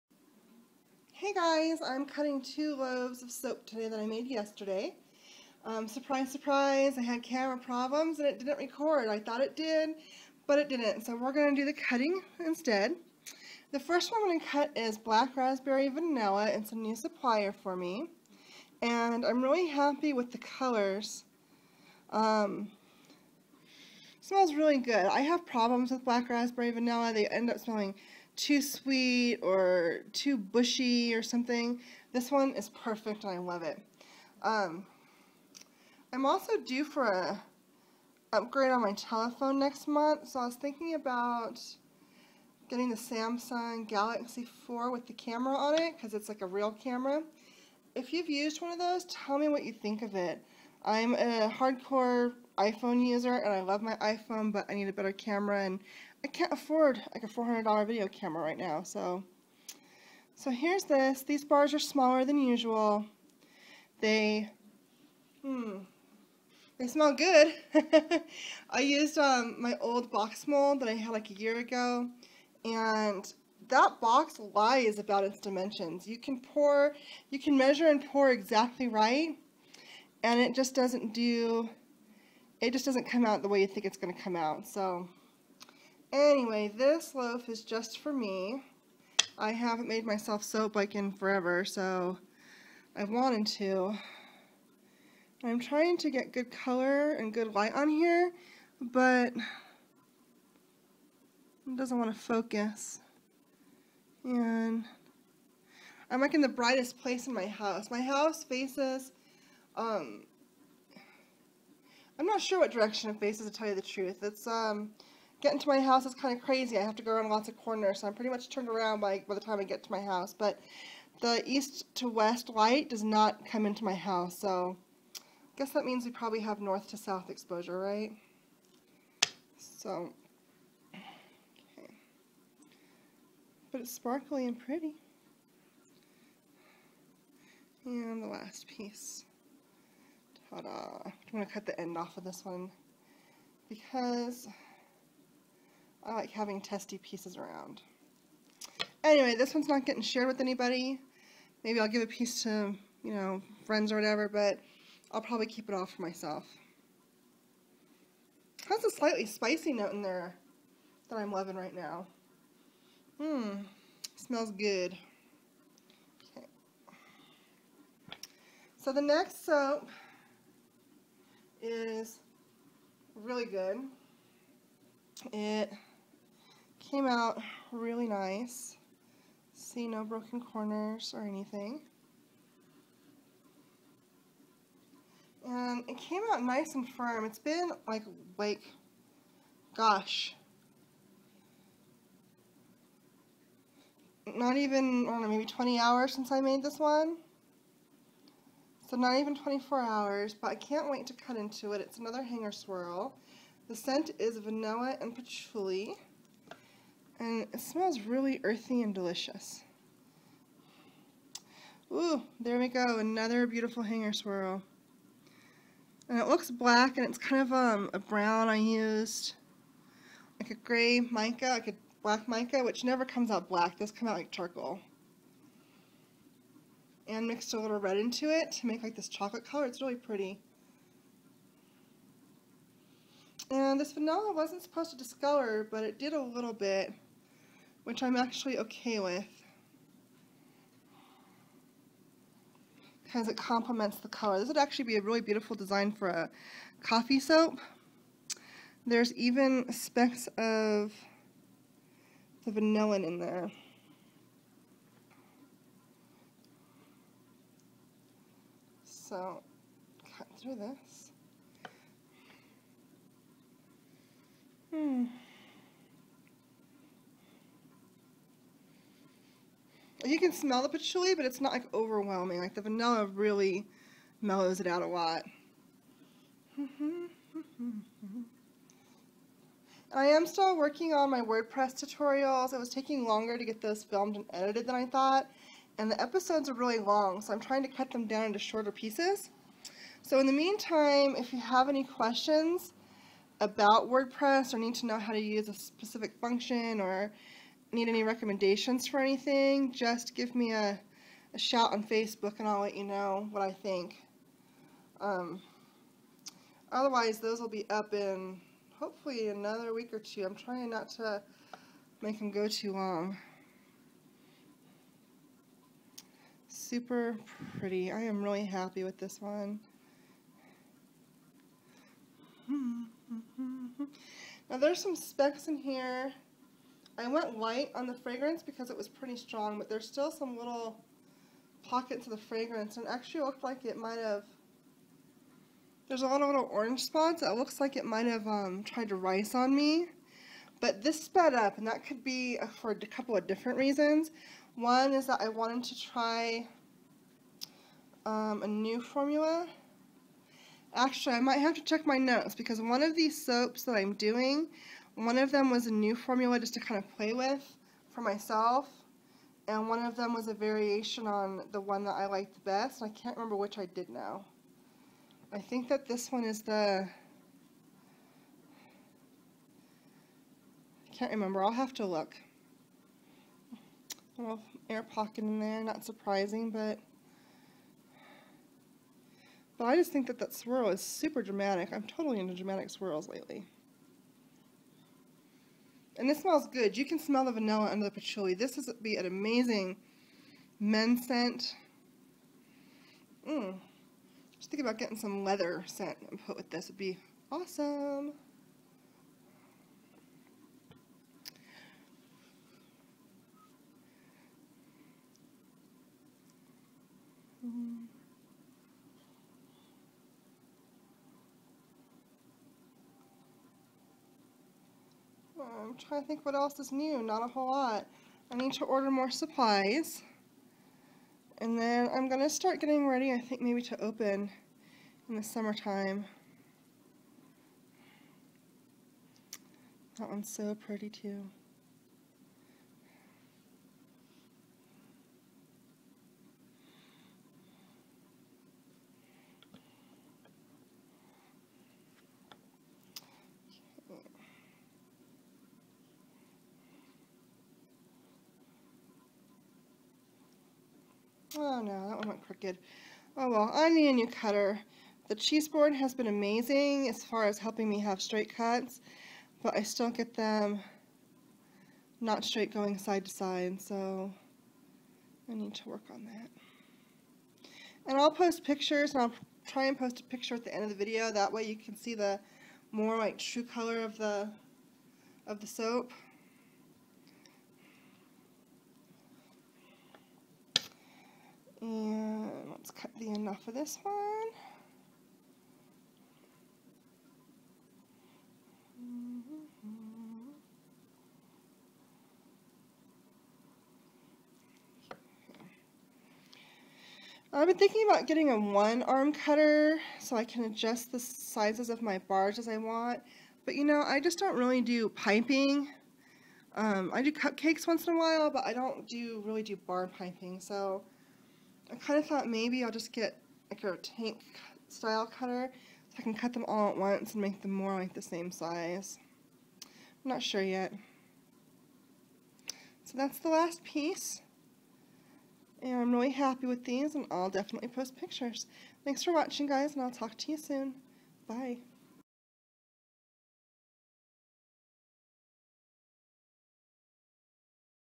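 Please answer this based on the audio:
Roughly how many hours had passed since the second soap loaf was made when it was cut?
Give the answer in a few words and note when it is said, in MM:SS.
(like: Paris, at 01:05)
20, at 03:15.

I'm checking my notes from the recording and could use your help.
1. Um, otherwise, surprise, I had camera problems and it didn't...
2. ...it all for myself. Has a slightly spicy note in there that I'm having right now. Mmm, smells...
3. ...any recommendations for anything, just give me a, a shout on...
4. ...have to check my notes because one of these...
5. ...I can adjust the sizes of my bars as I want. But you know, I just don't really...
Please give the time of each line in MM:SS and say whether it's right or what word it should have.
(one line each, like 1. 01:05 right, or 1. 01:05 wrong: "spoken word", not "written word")
1. 00:05 wrong: "surprise", not "otherwise"
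2. 02:35 wrong: "loving", not "having"
3. 04:57 right
4. 05:51 right
5. 08:20 right.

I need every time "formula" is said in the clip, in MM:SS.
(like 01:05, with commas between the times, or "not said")
05:48, 05:55.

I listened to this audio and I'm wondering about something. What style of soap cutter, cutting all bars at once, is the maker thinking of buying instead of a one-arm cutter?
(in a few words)
Tank style cutter.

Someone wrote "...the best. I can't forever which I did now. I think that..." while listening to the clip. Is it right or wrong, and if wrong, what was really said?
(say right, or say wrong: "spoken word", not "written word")
wrong: "remember", not "forever".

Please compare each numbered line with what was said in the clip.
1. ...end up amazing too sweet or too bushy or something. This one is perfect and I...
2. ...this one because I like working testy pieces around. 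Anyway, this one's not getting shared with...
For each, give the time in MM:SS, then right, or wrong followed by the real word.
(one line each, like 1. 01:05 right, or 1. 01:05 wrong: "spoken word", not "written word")
1. 00:27 wrong: "smelling", not "amazing"
2. 02:22 wrong: "having", not "working".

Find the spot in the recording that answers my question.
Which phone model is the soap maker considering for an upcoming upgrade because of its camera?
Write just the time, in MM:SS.
00:42.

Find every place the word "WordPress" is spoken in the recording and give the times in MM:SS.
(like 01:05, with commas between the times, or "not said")
04:41, 04:53.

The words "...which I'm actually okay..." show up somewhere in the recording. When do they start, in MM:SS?
03:57.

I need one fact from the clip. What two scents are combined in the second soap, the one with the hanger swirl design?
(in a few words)
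Vanilla and patchouli.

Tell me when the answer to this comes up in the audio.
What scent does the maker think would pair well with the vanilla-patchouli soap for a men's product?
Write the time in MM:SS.
06:35.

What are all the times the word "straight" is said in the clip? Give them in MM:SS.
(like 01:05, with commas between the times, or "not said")
07:38, 07:42.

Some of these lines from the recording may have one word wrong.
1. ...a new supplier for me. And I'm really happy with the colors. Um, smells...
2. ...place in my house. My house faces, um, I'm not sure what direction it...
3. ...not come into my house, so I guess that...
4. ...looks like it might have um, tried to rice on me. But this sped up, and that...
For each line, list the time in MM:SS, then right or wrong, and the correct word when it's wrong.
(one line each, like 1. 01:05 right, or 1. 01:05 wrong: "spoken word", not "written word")
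1. 00:16 right
2. 01:46 right
3. 02:03 right
4. 05:37 right.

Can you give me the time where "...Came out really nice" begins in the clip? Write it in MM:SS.
02:56.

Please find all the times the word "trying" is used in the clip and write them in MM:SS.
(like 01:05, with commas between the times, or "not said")
01:35, 04:47, 05:10, 06:55.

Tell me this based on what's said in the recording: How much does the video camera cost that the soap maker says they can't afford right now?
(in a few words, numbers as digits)
$400.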